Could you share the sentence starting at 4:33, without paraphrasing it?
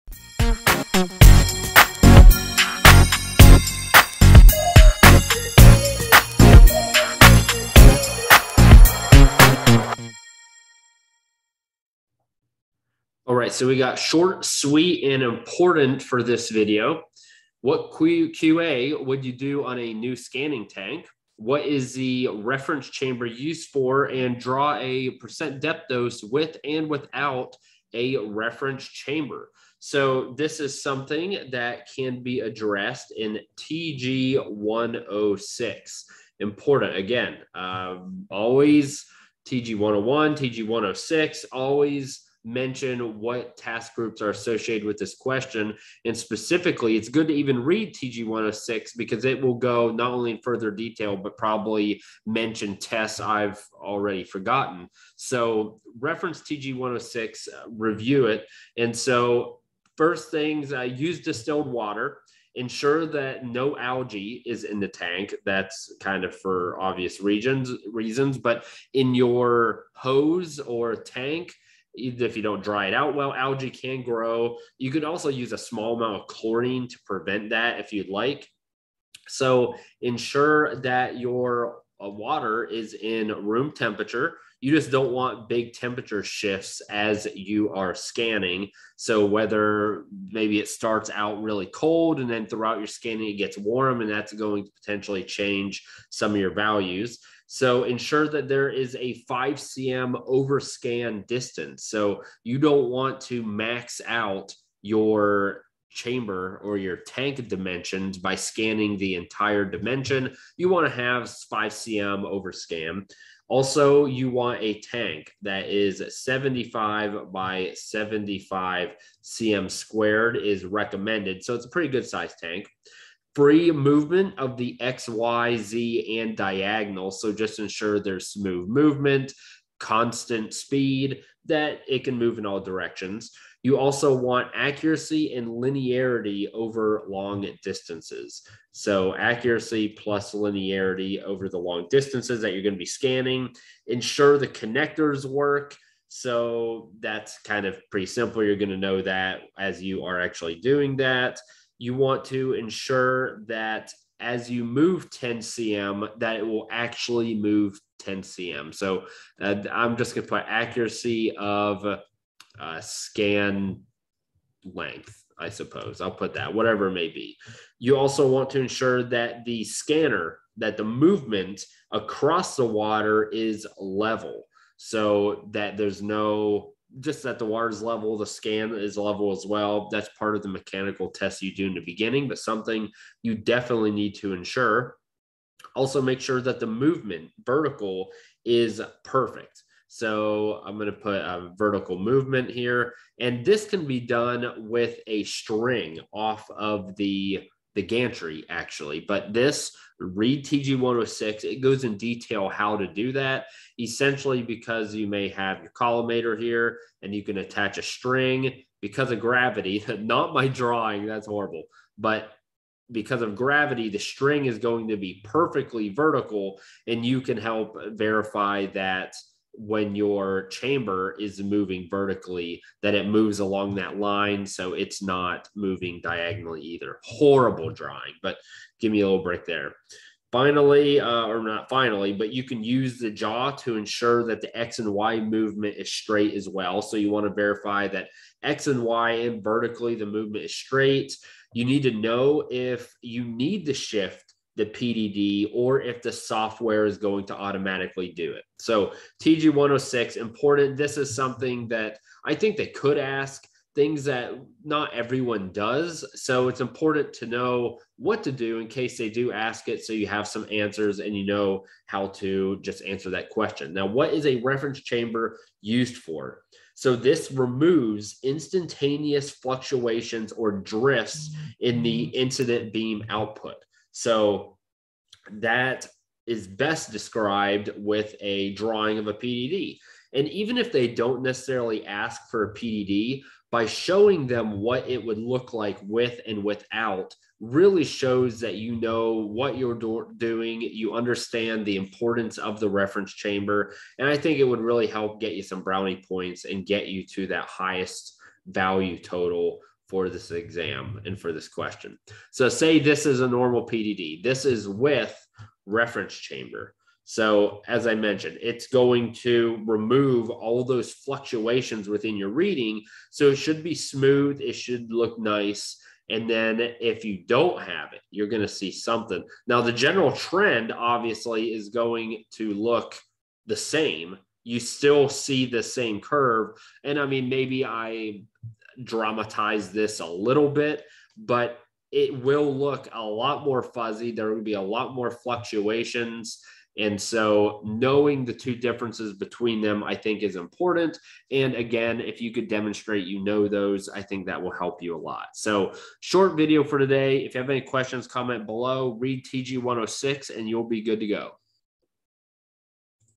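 So that is best described with a drawing of a PDD.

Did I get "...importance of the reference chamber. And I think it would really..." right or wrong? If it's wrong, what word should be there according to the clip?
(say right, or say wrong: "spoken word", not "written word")
right.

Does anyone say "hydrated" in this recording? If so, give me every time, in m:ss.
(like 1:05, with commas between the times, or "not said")
not said.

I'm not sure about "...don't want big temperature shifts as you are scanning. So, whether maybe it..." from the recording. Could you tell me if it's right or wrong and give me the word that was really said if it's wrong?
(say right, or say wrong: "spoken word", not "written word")
right.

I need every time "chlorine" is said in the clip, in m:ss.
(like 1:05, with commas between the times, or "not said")
1:16.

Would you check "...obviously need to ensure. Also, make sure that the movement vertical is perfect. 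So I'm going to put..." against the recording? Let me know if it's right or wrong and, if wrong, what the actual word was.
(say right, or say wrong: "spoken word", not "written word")
wrong: "definitely", not "obviously".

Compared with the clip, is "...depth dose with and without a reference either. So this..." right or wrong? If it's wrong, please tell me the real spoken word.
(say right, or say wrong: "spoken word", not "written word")
wrong: "chamber", not "either".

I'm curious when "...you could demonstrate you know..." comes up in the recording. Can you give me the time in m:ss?
5:42.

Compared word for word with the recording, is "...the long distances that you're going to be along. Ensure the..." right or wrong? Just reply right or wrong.
wrong.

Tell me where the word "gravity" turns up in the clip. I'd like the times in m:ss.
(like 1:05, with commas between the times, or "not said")
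3:29, 3:33.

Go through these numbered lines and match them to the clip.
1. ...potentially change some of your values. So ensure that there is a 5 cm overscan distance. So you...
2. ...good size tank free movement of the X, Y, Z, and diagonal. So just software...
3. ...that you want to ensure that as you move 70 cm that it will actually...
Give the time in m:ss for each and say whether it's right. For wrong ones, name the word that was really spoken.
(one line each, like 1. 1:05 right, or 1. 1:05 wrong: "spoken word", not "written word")
1. 1:34 right
2. 2:01 wrong: "ensure", not "software"
3. 2:30 wrong: "10", not "70".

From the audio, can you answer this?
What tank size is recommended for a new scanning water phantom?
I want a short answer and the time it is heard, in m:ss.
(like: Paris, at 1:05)
75 by 75 cm, at 1:56.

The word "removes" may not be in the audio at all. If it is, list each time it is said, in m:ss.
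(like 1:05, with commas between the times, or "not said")
4:27, 5:09.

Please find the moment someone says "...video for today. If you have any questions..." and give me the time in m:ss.
5:46.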